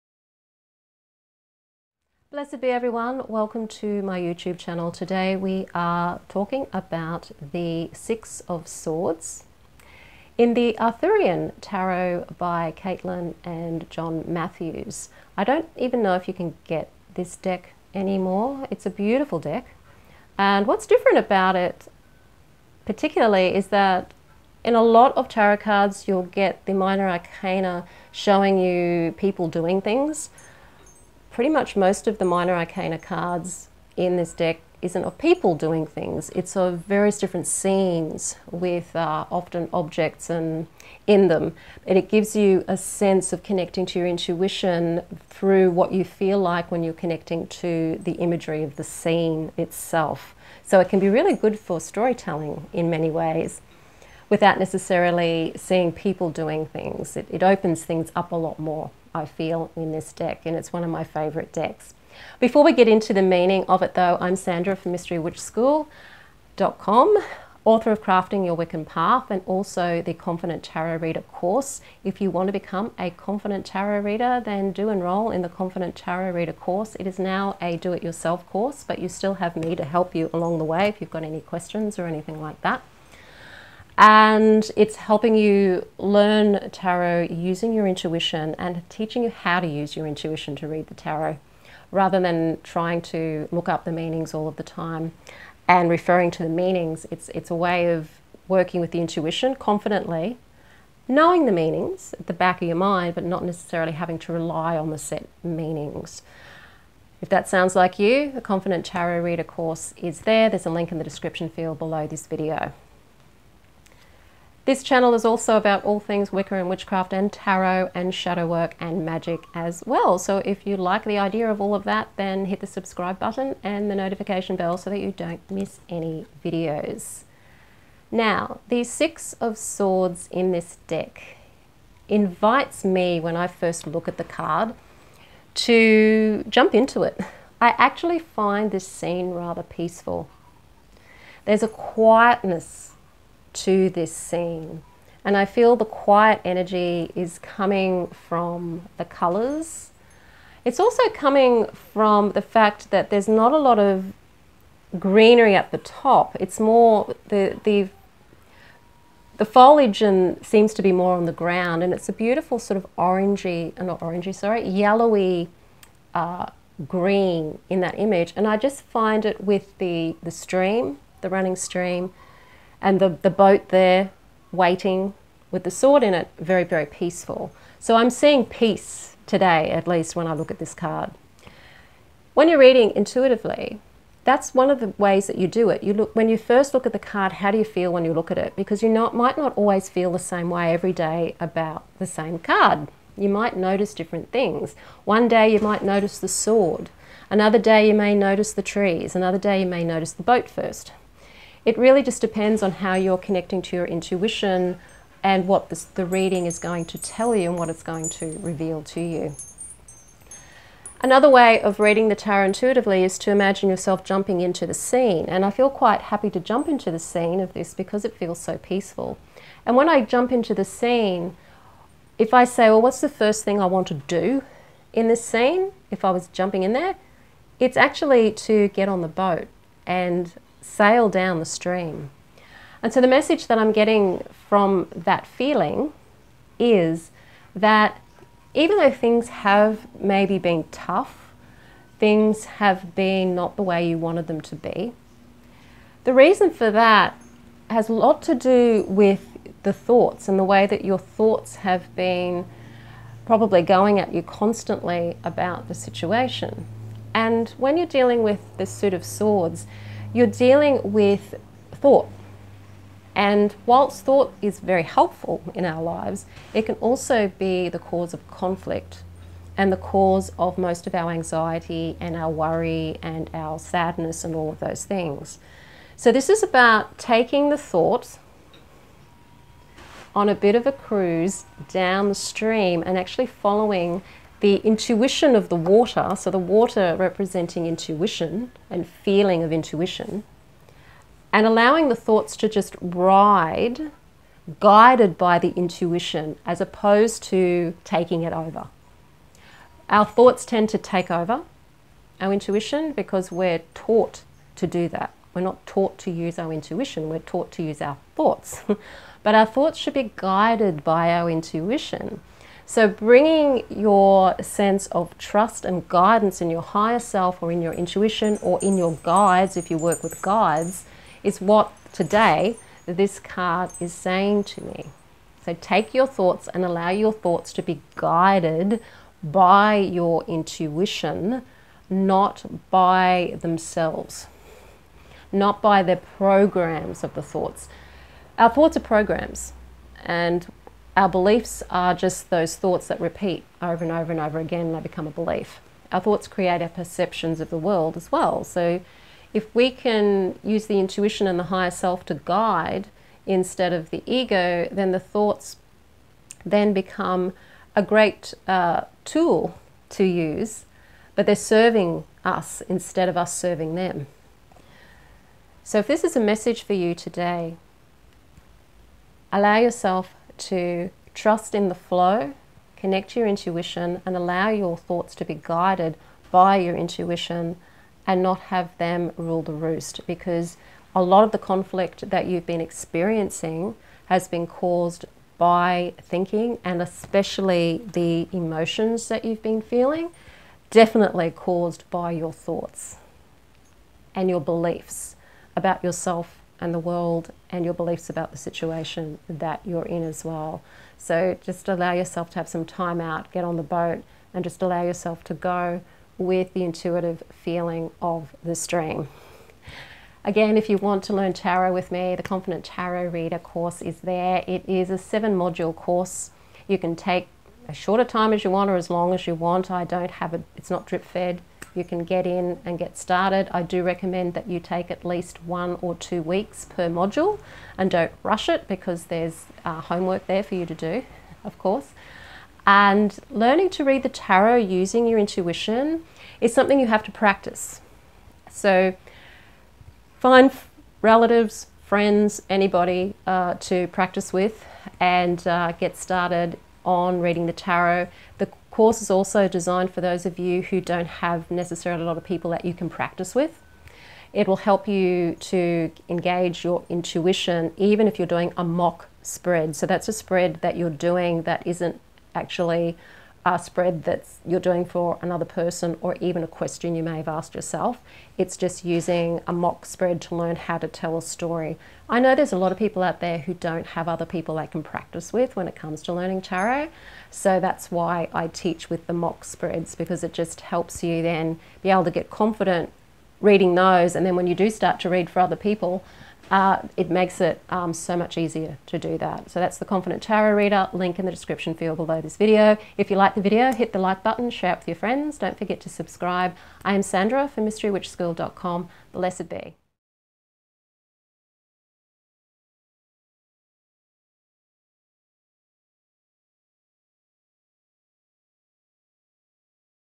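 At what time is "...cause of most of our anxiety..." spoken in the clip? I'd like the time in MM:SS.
04:29.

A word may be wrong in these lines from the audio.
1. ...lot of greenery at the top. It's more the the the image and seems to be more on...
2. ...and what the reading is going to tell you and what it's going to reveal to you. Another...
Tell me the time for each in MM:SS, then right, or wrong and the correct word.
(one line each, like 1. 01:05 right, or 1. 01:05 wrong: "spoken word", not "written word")
1. 02:33 wrong: "foliage", not "image"
2. 03:25 right.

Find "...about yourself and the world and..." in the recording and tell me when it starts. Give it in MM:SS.
06:35.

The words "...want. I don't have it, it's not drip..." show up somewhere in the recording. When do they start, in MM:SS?
06:59.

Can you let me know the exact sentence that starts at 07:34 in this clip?
It will help you to engage your intuition even if you're doing a mock spread.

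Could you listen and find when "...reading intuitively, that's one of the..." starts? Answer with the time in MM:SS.
03:02.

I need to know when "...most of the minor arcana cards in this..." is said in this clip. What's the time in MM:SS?
00:31.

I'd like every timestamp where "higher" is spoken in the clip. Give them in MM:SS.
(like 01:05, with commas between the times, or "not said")
05:16, 05:51.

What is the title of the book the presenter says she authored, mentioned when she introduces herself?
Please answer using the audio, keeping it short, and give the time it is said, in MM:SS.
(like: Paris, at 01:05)
Crafting Your Wiccan Path, at 01:08.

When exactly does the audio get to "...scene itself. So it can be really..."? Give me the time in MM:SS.
00:48.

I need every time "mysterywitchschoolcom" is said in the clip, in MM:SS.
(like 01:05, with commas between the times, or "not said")
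01:04, 08:17.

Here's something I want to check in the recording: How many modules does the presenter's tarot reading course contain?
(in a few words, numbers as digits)
7.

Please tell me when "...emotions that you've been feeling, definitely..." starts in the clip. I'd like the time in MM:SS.
06:28.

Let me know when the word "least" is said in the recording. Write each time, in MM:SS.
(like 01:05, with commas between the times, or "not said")
02:59, 07:05.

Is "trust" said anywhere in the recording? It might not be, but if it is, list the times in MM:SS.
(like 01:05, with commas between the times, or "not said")
05:15, 06:11.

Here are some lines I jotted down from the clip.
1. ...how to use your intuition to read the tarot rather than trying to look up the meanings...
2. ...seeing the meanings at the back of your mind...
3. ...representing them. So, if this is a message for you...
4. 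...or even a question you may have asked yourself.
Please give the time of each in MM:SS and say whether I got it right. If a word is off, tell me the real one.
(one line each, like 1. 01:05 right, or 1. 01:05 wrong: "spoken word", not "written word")
1. 01:29 right
2. 01:41 wrong: "knowing", not "seeing"
3. 06:03 wrong: "serving", not "representing"
4. 07:46 right.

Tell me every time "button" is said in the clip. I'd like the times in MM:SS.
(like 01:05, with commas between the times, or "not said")
02:03, 08:14.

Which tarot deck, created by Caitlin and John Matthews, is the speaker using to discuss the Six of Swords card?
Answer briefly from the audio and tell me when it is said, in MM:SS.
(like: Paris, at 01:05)
Arthurian Tarot, at 00:10.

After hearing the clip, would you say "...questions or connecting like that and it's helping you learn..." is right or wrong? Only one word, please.
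wrong.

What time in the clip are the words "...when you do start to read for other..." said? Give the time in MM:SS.
08:04.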